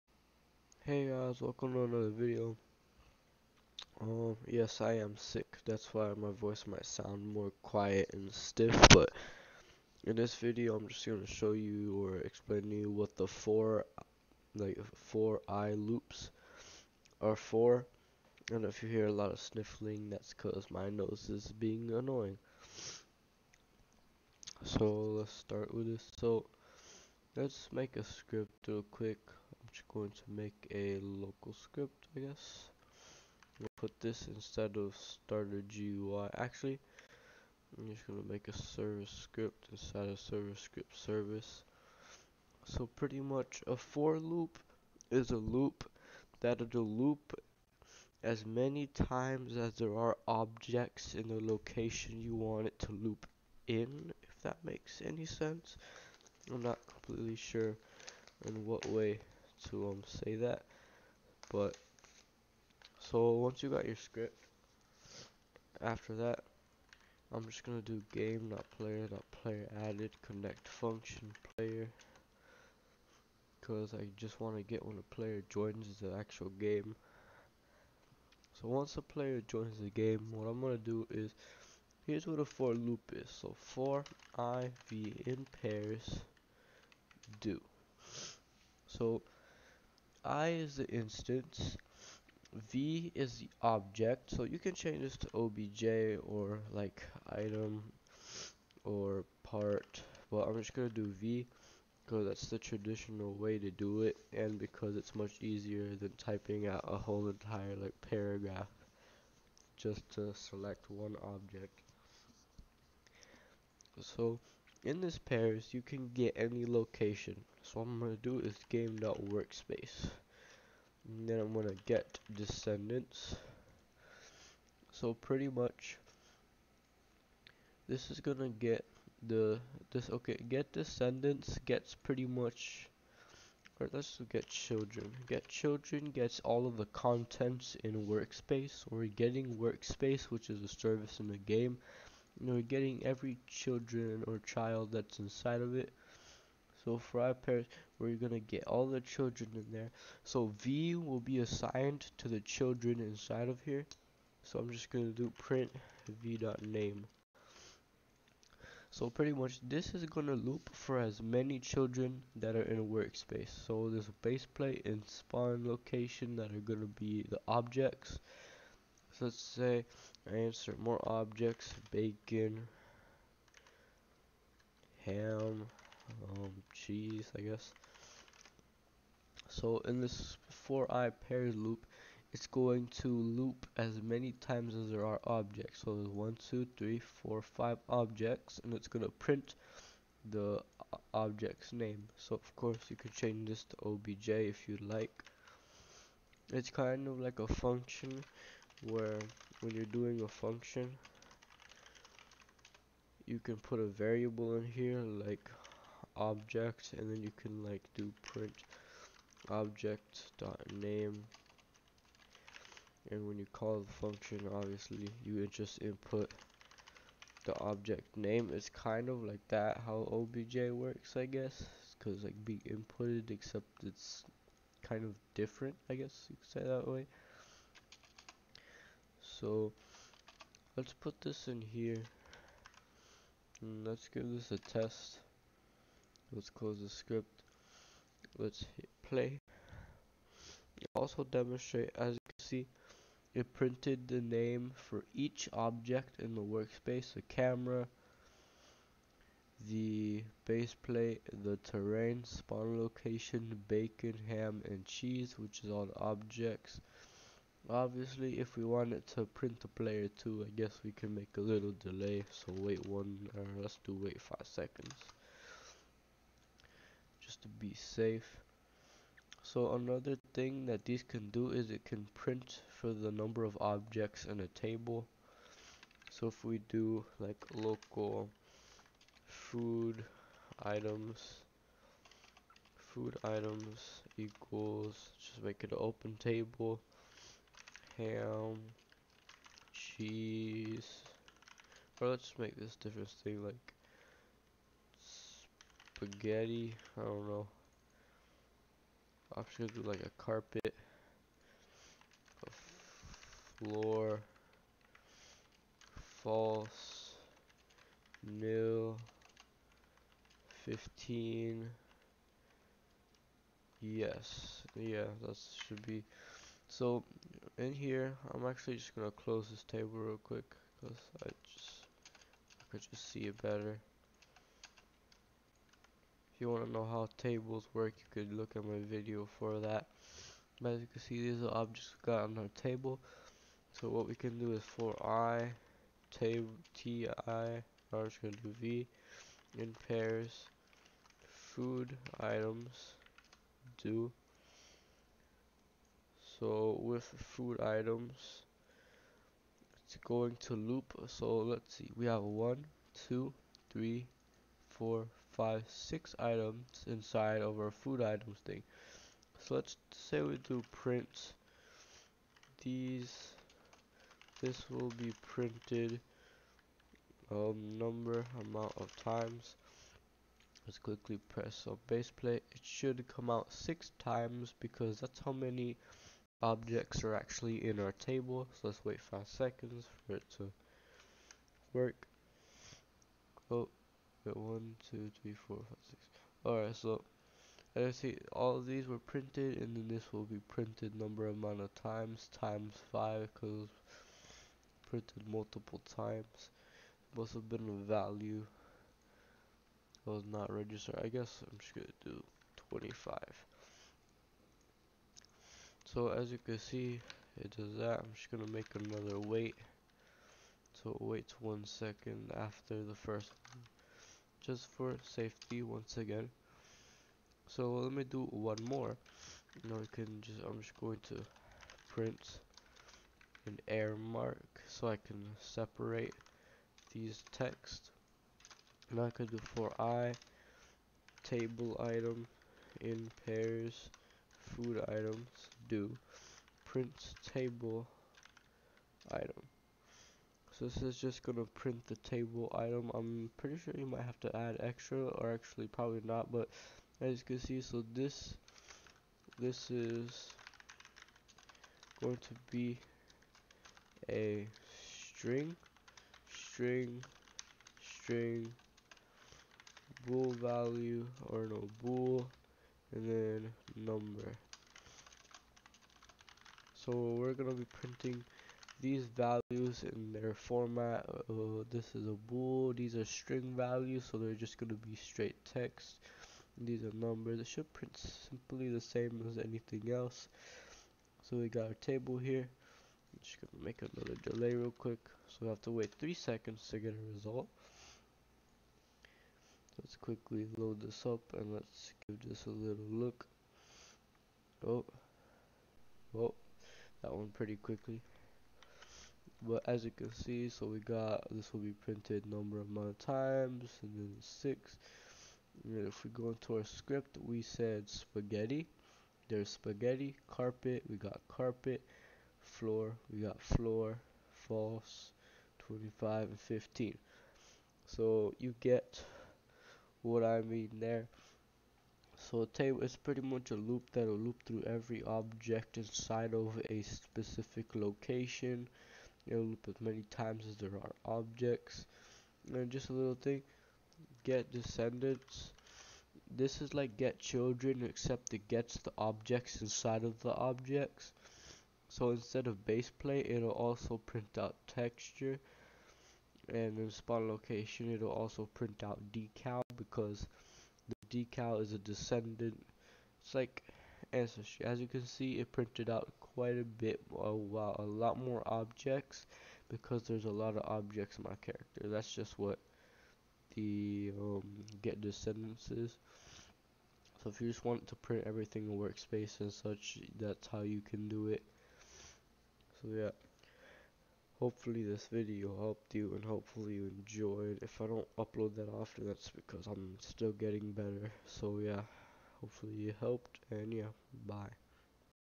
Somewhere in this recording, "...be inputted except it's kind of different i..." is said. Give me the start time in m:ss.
3:42.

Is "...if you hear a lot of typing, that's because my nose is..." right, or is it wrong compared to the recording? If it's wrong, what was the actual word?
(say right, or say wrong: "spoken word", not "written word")
wrong: "sniffling", not "typing".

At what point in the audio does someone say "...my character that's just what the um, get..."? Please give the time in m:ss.
9:21.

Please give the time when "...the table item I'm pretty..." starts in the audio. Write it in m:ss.
7:21.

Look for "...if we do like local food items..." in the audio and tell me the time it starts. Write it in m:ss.
4:36.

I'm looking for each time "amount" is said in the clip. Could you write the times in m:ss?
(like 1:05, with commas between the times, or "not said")
6:08, 6:31, 8:22.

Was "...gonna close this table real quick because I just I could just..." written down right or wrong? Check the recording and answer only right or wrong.
right.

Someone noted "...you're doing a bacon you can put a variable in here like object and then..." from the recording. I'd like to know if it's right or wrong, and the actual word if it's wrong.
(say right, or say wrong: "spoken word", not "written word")
wrong: "function", not "bacon".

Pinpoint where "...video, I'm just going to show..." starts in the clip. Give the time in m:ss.
0:10.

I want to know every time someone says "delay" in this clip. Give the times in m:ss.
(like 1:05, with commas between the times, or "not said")
4:21, 8:04.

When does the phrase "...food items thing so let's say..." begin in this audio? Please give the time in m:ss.
5:57.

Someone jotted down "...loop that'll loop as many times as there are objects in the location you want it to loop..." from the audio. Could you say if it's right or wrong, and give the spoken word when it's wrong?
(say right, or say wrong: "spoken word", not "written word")
right.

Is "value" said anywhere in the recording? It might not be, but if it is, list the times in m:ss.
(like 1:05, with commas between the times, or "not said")
6:37, 7:40, 7:49, 7:53.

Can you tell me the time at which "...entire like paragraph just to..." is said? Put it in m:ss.
1:47.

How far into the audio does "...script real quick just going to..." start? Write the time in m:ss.
0:28.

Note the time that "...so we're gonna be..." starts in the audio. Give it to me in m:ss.
7:46.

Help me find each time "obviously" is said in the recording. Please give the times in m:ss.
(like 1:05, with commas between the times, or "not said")
3:34, 4:17.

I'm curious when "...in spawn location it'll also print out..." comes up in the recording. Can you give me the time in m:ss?
9:06.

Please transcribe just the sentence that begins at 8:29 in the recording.
There's spaghetti, carpet, we got carpet, floor, we got floor, false, 25, and 15.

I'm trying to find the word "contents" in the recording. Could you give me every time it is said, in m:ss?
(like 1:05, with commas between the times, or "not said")
2:16.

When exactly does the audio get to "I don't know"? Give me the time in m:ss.
4:56.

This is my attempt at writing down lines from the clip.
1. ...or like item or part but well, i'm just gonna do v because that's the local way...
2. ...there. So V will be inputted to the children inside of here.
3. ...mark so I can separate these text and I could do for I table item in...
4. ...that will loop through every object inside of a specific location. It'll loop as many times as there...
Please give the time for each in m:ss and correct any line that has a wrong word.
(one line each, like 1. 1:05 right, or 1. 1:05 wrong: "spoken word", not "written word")
1. 1:36 wrong: "traditional", not "local"
2. 2:29 wrong: "assigned", not "inputted"
3. 7:03 right
4. 8:43 right.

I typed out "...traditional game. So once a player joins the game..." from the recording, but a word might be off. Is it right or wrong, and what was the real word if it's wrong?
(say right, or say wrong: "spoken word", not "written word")
wrong: "actual", not "traditional".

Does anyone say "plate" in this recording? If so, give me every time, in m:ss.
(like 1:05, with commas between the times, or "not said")
2:44, 4:10, 6:12, 9:02.